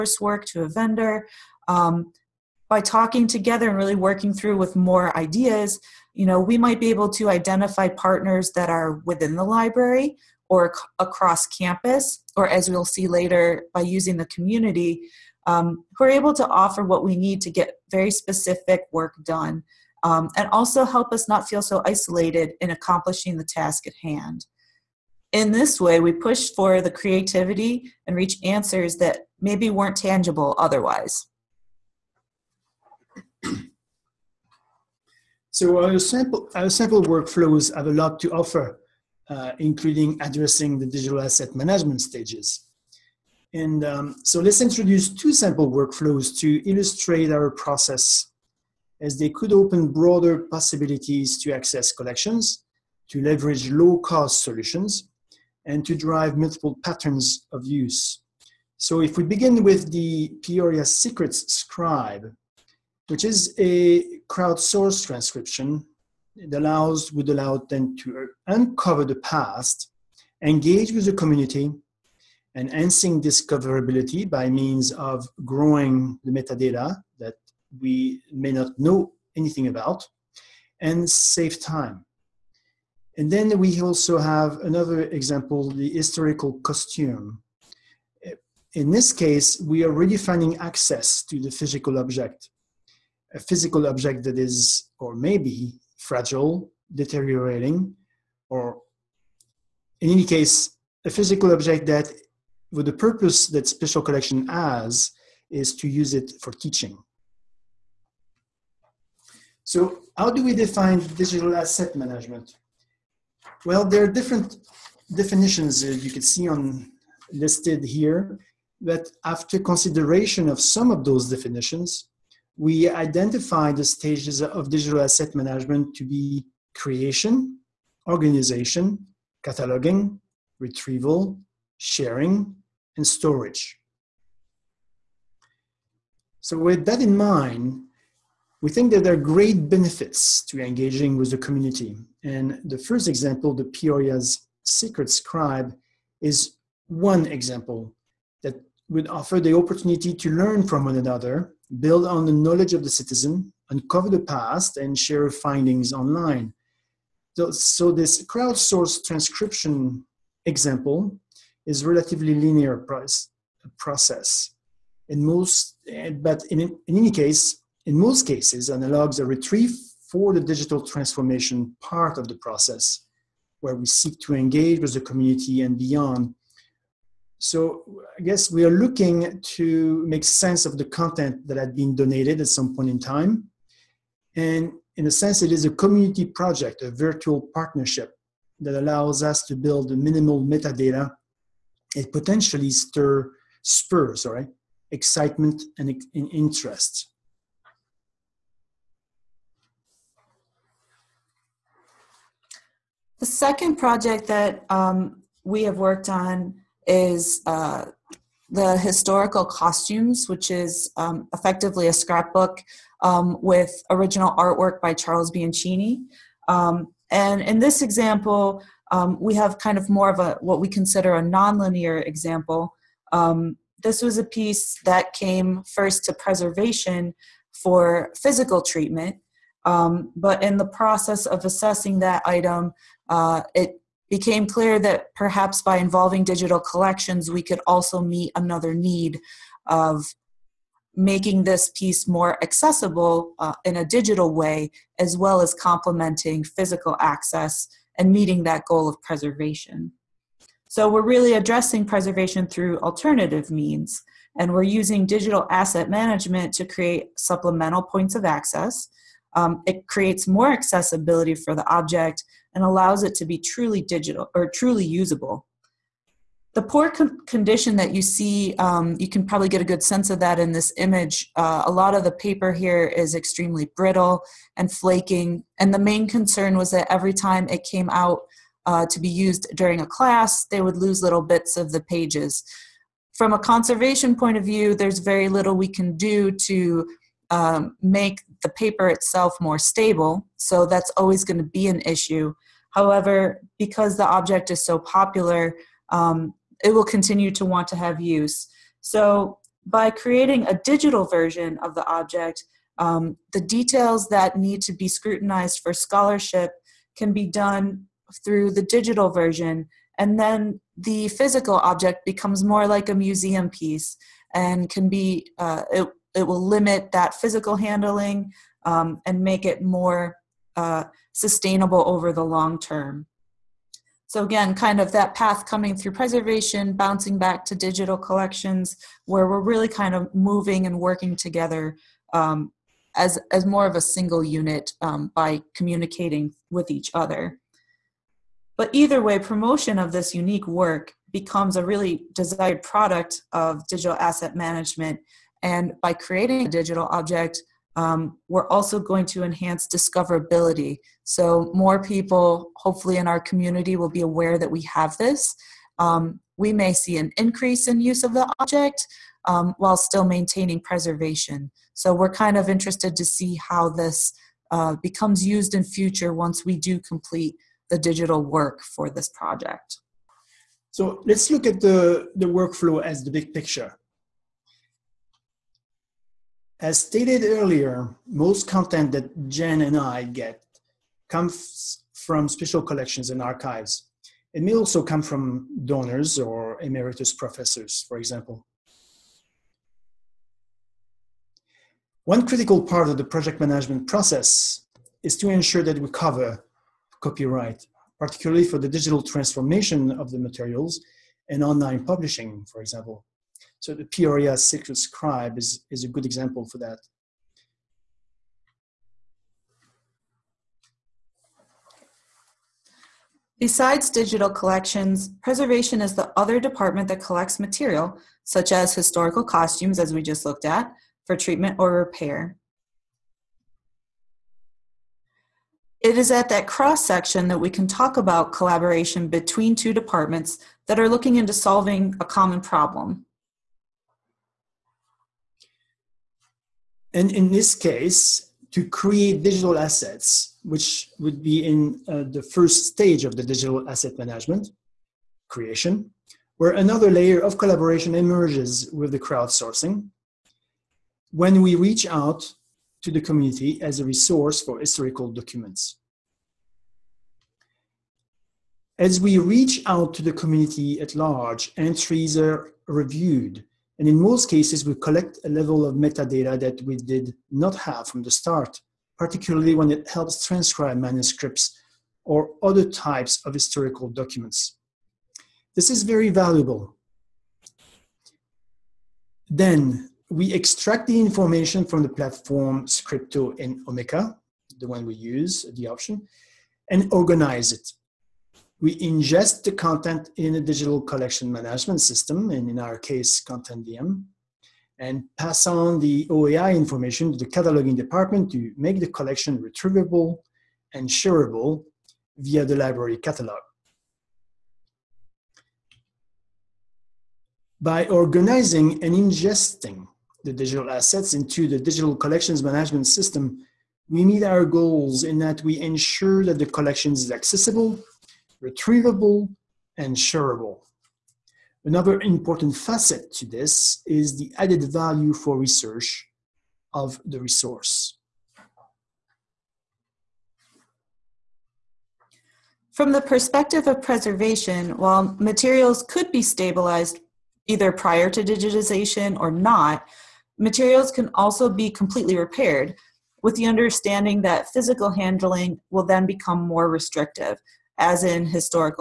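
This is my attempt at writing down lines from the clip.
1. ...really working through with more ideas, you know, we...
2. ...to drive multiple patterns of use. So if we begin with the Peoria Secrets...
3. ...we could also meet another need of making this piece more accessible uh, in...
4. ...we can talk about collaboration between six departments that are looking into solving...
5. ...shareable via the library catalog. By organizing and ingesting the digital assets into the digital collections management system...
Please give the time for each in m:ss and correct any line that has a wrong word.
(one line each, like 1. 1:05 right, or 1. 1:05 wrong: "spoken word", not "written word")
1. 0:03 right
2. 0:55 right
3. 3:57 right
4. 7:07 wrong: "two", not "six"
5. 8:20 right.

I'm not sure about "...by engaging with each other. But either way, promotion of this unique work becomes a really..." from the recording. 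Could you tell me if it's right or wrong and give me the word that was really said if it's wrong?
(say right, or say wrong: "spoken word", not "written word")
wrong: "communicating", not "engaging".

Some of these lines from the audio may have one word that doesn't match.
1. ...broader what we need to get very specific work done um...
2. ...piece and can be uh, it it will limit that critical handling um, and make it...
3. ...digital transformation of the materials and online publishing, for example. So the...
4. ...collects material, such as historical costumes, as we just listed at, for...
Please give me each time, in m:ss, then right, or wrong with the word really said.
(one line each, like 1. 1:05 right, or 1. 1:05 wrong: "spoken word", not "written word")
1. 0:16 wrong: "offer", not "broader"
2. 5:13 wrong: "physical", not "critical"
3. 6:38 right
4. 6:57 wrong: "looked", not "listed".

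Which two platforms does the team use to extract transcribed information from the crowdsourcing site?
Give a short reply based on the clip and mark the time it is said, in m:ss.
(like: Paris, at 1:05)
Scripto and Omeka, at 8:02.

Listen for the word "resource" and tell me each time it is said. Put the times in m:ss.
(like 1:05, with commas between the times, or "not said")
7:33, 8:47.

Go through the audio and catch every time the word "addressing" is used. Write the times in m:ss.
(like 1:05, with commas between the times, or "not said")
0:40, 4:11.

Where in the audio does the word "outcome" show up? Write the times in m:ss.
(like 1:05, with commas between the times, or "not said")
not said.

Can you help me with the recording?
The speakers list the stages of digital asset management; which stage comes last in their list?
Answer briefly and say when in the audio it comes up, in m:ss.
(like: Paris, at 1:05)
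storage, at 2:13.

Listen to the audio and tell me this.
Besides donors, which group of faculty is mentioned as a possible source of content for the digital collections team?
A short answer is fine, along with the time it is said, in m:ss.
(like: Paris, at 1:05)
emeritus professors, at 6:26.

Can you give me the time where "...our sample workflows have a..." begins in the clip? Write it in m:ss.
0:36.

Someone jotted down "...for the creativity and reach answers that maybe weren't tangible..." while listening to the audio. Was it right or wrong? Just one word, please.
right.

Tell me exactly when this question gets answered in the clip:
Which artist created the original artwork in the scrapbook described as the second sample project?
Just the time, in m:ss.
3:34.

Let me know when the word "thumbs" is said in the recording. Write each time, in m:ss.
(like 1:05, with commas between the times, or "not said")
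not said.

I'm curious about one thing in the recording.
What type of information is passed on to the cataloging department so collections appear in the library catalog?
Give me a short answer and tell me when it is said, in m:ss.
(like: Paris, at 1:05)
OAI information, at 8:16.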